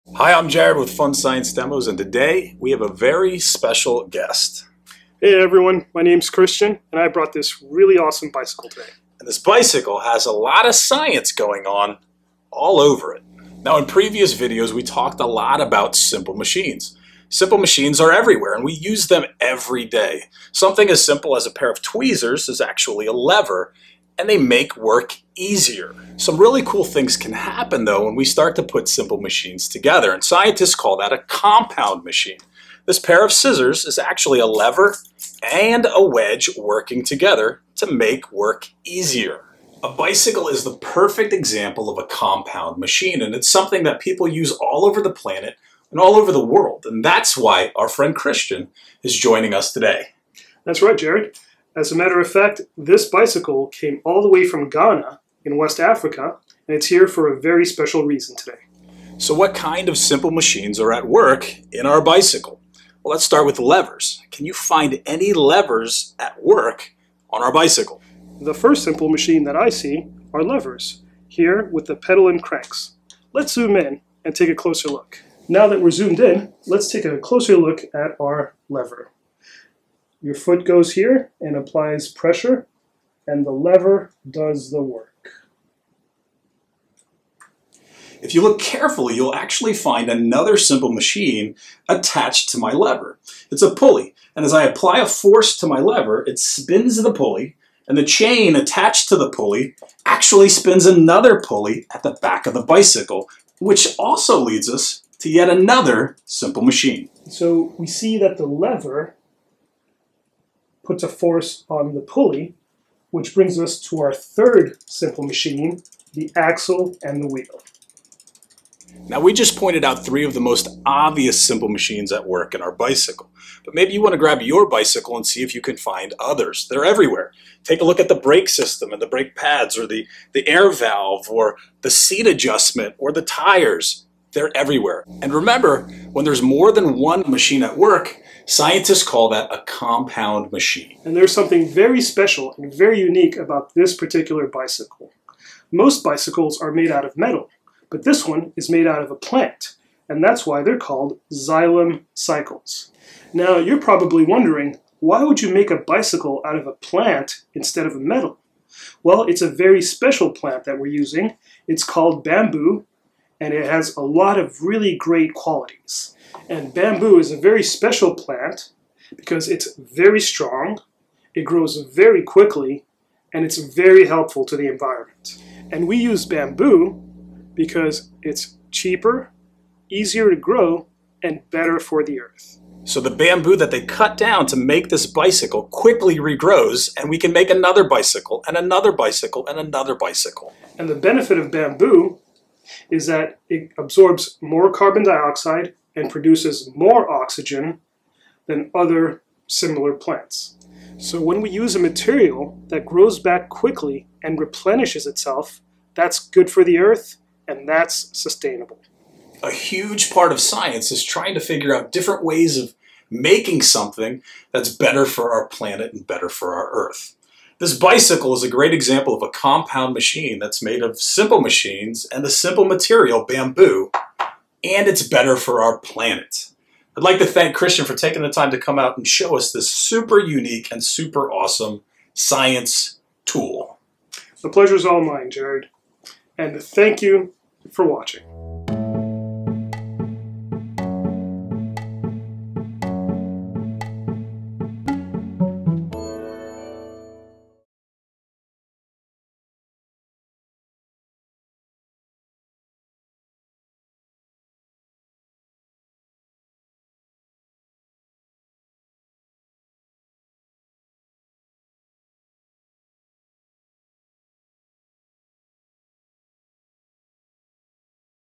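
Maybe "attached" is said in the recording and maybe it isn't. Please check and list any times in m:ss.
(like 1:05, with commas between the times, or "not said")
1:31, 1:38.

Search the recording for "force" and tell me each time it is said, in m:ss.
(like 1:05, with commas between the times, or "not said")
1:35, 1:51.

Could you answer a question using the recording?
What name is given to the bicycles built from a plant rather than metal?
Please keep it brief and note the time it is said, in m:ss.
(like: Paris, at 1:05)
Xylem cycles, at 2:31.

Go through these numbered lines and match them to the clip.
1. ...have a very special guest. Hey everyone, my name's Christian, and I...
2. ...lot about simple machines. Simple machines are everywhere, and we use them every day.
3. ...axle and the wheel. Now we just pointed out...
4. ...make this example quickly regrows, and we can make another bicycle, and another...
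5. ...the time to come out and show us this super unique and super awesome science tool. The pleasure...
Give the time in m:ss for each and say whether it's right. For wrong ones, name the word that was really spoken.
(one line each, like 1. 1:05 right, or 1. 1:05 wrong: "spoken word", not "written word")
1. 0:02 right
2. 0:15 right
3. 1:56 right
4. 3:04 wrong: "bicycle", not "example"
5. 3:48 right.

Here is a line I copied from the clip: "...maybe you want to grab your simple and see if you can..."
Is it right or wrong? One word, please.
wrong.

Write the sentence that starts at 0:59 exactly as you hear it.
So what kind of simple machines are at work in our bicycle?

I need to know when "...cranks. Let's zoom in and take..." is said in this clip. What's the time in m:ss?
1:12.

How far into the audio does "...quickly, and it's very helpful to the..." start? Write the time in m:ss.
2:52.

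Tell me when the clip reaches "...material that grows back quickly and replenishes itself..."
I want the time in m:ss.
3:21.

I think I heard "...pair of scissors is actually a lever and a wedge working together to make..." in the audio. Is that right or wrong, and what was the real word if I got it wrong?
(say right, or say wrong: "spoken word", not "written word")
right.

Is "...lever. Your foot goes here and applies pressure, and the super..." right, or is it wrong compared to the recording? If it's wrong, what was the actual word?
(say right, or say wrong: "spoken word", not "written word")
wrong: "lever", not "super".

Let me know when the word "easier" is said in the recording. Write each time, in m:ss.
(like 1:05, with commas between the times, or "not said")
0:25, 0:38, 2:59.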